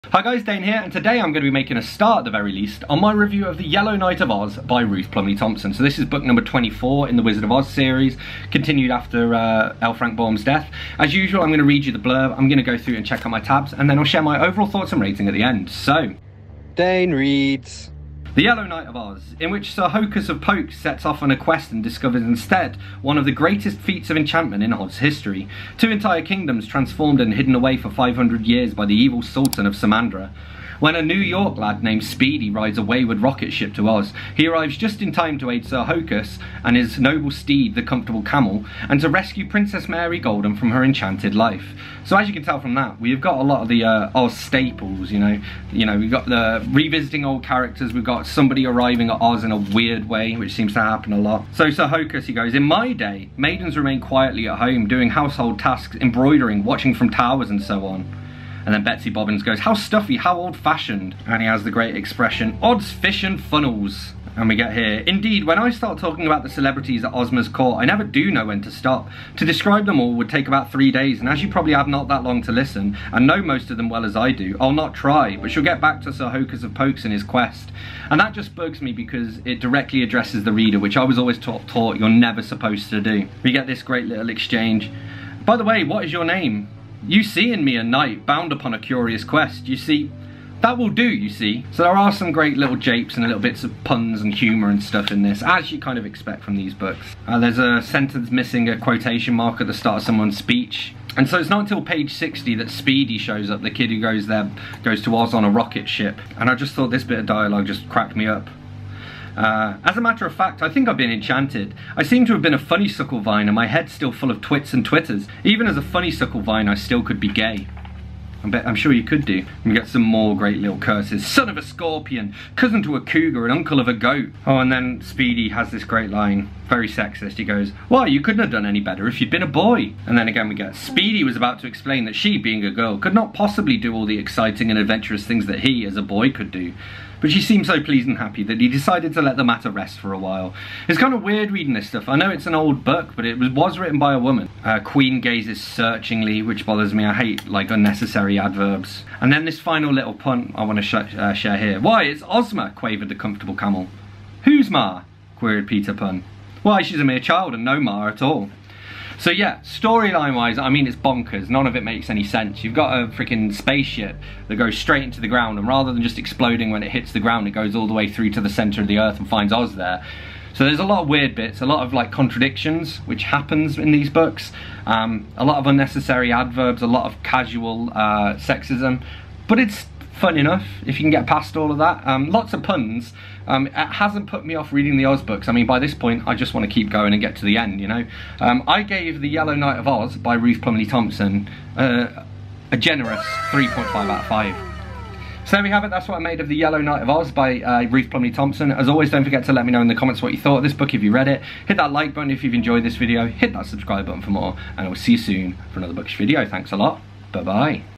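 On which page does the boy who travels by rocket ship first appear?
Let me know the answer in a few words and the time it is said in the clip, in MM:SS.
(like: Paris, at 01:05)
60, at 01:41.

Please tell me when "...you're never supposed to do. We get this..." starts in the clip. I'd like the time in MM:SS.
01:21.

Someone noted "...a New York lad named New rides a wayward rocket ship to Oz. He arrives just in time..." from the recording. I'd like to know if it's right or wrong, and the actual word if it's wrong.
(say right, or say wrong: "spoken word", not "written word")
wrong: "Speedy", not "New".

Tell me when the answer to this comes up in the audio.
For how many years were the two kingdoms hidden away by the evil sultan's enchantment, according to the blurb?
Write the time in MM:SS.
00:27.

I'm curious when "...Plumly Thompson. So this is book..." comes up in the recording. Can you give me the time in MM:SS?
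00:05.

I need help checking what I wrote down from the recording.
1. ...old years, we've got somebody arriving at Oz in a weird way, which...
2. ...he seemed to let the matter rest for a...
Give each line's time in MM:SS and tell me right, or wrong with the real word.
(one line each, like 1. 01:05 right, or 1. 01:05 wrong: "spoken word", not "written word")
1. 00:47 wrong: "characters", not "years"
2. 02:18 wrong: "decided", not "seemed".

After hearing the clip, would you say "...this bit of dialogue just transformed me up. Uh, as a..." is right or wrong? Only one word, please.
wrong.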